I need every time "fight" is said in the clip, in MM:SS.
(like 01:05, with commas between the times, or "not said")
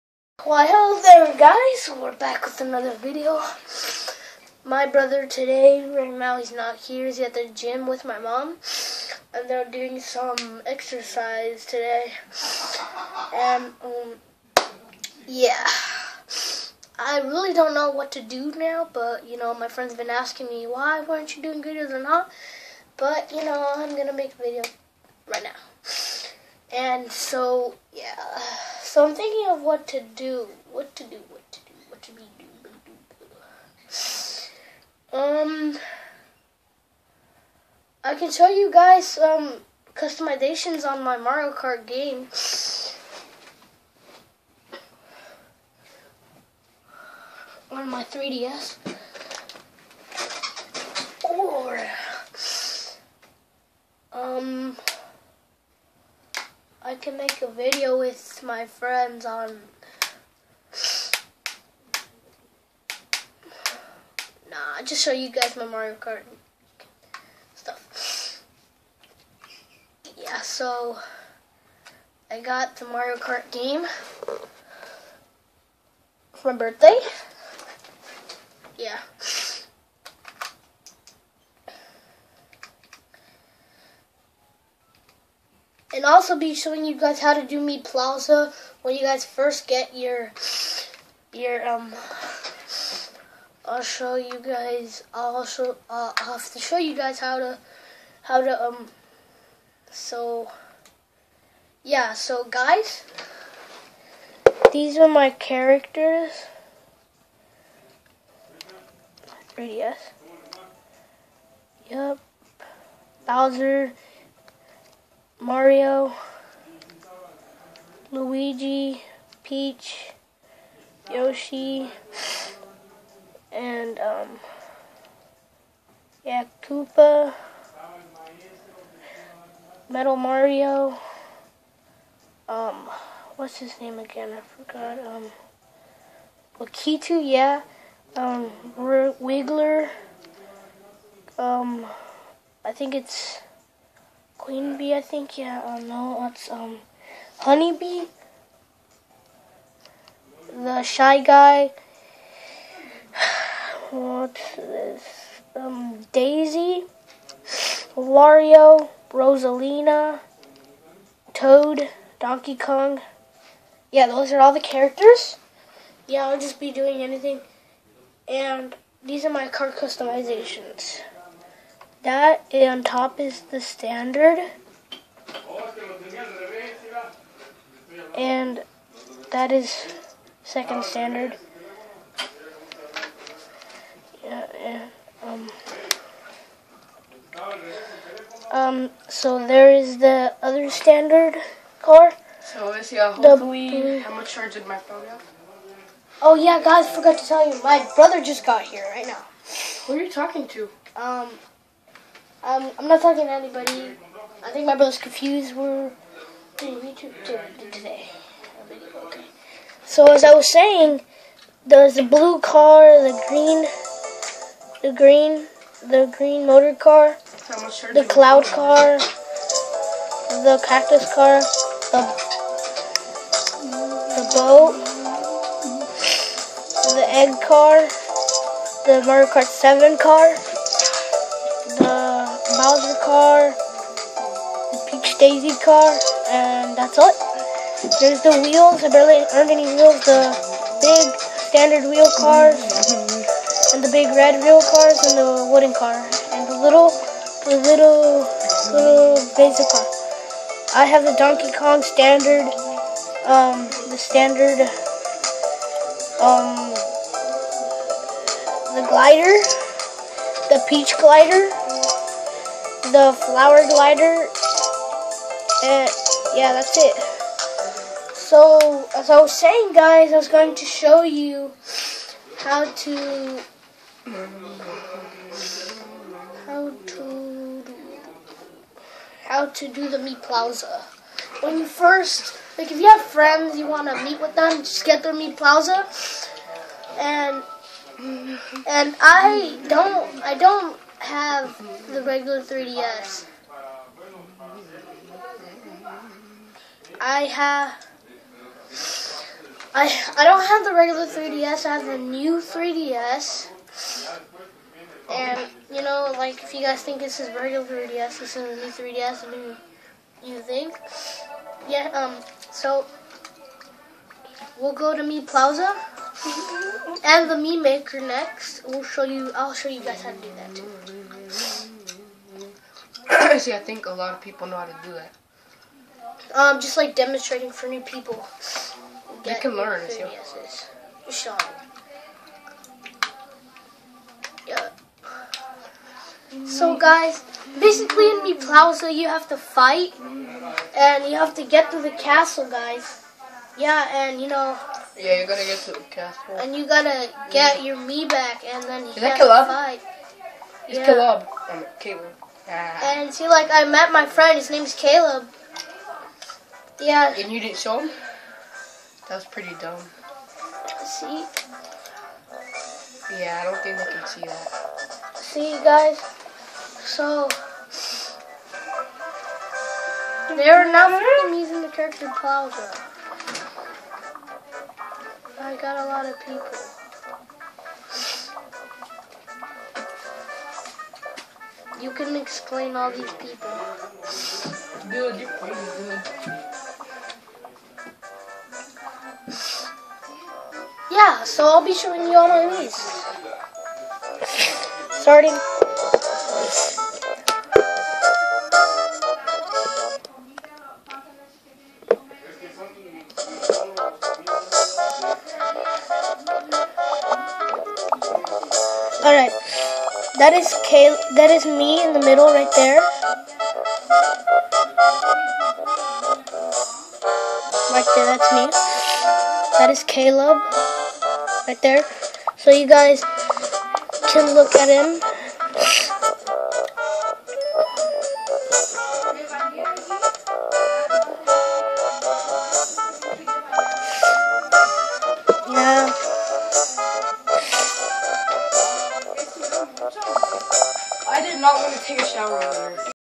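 05:39, 05:49.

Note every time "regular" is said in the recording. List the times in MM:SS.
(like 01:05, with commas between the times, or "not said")
04:52, 05:00, 05:07.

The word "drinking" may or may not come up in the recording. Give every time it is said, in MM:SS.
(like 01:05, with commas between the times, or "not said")
not said.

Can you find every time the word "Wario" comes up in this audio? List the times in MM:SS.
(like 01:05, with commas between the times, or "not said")
02:37.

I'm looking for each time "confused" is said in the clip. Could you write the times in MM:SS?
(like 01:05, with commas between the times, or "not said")
03:24.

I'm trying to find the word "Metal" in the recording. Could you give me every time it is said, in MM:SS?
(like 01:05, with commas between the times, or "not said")
02:09.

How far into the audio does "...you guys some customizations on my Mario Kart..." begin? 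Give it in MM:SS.
00:38.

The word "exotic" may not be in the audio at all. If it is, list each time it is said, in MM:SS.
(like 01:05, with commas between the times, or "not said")
not said.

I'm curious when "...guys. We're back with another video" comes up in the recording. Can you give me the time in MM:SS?
00:01.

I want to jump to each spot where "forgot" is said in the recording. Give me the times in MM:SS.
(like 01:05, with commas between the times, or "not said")
02:14, 03:16.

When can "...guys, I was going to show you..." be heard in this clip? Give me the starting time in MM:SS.
04:29.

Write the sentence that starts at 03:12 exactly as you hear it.
So uh, this, yeah, hopefully, how much charge did my phone have?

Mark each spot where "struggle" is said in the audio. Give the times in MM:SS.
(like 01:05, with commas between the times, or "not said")
not said.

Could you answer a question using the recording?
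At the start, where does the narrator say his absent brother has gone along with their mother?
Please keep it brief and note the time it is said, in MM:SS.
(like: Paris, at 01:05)
the gym, at 00:07.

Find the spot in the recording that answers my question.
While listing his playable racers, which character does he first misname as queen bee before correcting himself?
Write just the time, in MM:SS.
02:27.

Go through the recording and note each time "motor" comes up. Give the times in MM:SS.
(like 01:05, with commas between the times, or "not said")
03:36.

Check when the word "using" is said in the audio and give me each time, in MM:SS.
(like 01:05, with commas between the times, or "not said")
06:11.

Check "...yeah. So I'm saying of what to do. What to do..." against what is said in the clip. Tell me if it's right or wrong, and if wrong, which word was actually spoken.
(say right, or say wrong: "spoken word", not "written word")
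wrong: "thinking", not "saying".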